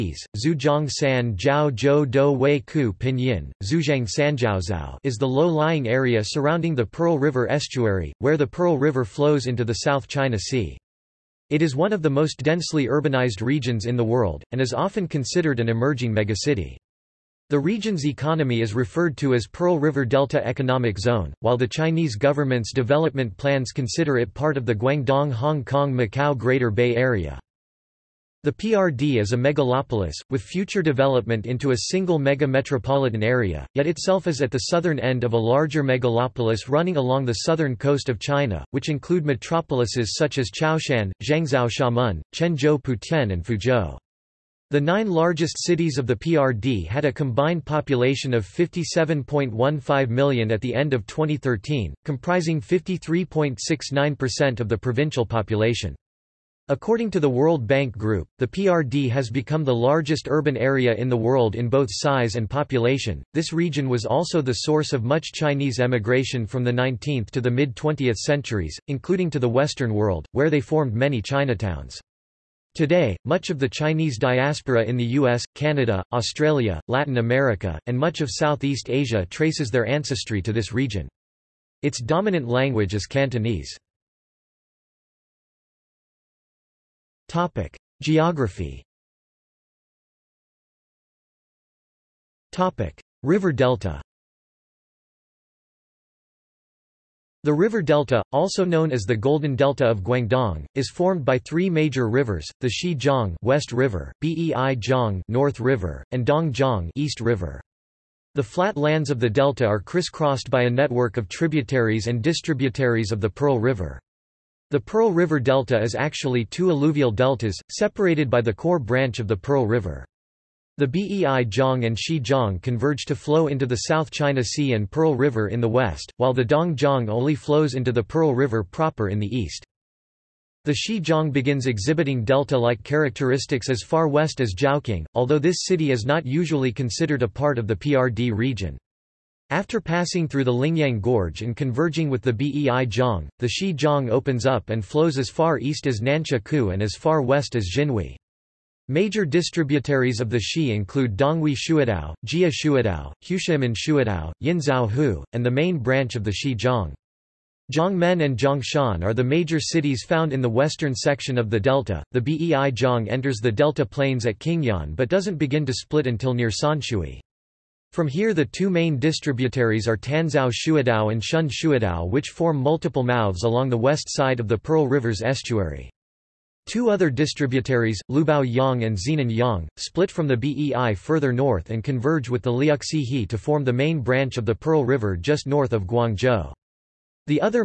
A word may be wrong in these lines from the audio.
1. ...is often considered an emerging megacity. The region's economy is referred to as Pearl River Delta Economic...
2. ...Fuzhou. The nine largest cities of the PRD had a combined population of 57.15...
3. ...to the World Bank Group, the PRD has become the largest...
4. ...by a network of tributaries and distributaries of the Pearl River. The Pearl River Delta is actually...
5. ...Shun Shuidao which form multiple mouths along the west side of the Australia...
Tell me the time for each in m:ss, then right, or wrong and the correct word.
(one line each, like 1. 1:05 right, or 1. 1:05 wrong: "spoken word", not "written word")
1. 0:14 right
2. 0:43 right
3. 0:57 right
4. 1:50 right
5. 2:51 wrong: "Pearl", not "Australia".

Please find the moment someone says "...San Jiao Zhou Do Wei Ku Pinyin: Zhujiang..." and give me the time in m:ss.
0:00.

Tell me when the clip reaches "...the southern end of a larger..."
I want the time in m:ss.
0:34.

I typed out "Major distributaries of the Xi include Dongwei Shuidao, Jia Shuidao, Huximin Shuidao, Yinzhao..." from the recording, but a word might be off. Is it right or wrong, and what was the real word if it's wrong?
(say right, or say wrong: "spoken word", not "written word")
right.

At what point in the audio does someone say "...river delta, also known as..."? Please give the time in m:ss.
1:37.